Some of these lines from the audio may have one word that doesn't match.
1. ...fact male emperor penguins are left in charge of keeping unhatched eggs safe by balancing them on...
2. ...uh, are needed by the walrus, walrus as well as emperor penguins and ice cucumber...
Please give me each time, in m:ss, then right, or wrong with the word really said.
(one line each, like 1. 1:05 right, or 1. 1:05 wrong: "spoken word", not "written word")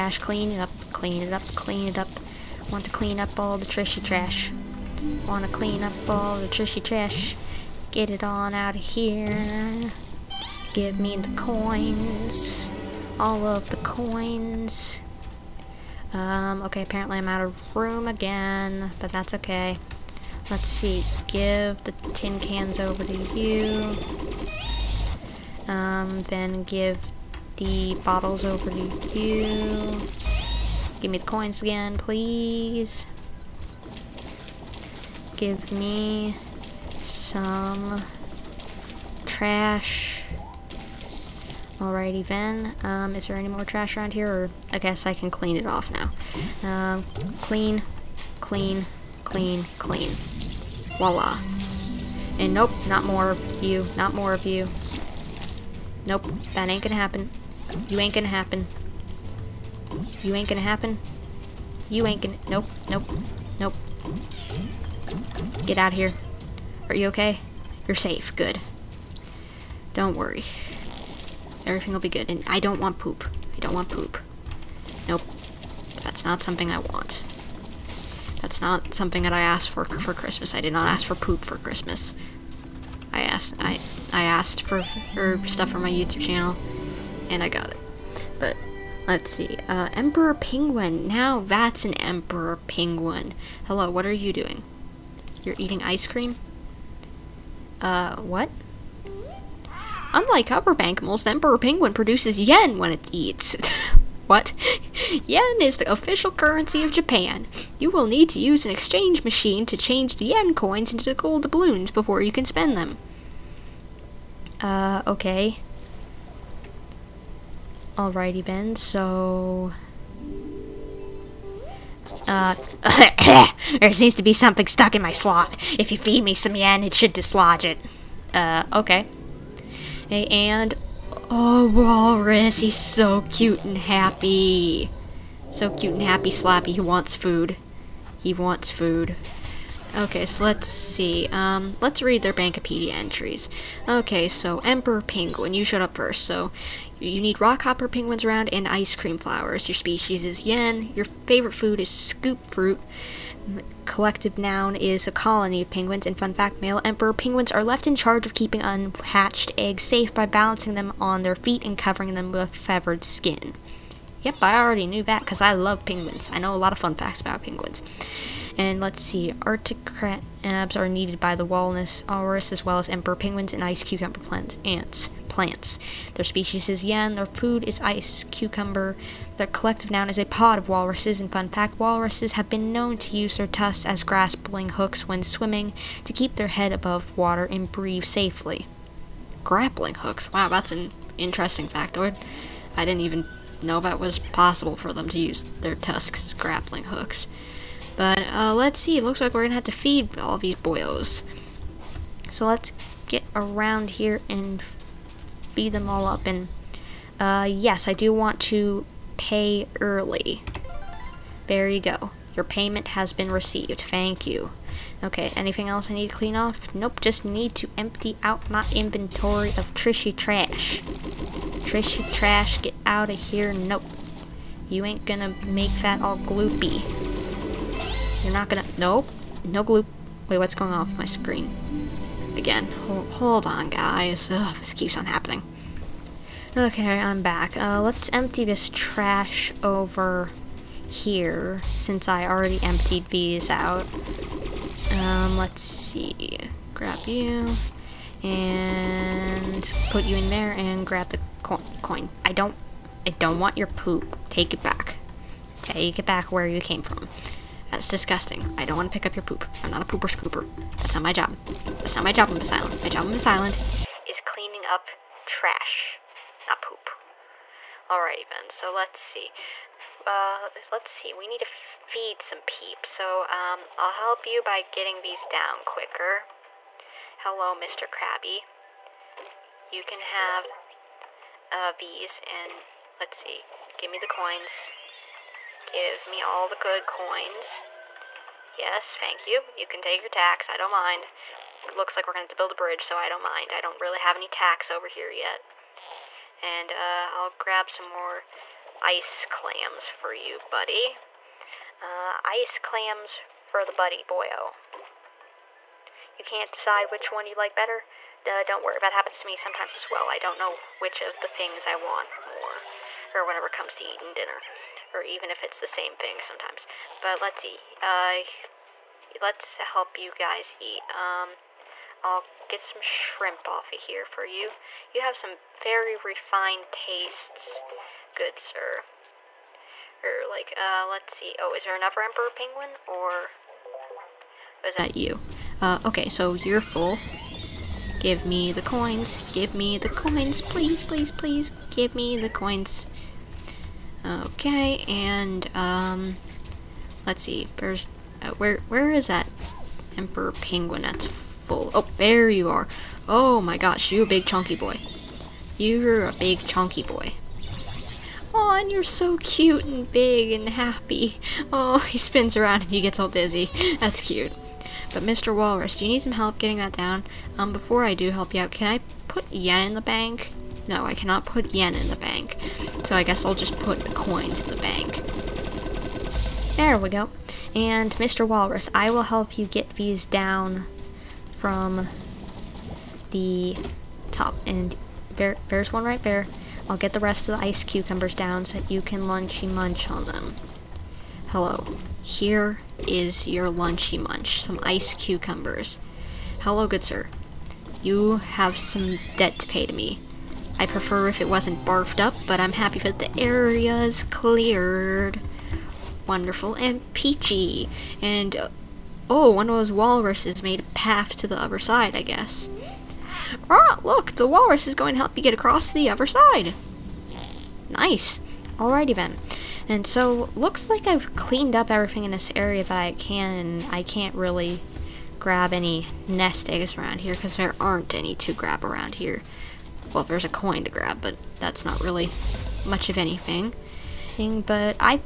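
1. 2:36 right
2. 2:50 right.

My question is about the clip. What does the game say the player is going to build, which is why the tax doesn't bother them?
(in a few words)
A bridge.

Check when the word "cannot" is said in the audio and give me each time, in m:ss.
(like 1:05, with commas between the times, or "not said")
6:10.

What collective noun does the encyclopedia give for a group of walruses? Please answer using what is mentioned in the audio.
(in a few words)
A pod.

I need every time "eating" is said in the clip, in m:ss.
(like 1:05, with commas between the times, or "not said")
1:35, 5:13.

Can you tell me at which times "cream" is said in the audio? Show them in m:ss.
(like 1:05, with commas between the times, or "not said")
1:36, 2:28.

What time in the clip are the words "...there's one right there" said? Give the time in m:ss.
6:25.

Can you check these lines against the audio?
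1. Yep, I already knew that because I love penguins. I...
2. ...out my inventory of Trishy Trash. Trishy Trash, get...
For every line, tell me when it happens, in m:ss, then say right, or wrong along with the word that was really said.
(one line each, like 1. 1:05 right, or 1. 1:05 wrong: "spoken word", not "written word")
1. 2:44 right
2. 3:38 right.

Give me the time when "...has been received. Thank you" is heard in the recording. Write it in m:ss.
3:32.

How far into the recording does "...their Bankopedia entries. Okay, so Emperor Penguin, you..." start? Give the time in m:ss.
2:22.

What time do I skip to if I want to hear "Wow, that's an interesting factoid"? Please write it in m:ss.
3:10.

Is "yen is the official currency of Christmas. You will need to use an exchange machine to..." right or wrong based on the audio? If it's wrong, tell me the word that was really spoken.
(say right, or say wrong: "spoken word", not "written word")
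wrong: "Japan", not "Christmas".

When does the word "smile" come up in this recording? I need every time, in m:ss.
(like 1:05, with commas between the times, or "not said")
not said.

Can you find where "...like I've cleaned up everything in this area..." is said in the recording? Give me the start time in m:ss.
7:00.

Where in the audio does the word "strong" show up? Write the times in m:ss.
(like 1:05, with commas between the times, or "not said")
not said.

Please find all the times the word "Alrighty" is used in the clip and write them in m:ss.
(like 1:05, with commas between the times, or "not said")
0:41, 1:57, 4:27, 6:58.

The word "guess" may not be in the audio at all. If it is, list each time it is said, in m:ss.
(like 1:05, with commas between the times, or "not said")
0:44, 6:13, 6:52.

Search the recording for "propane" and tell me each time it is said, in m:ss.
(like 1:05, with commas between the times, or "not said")
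not said.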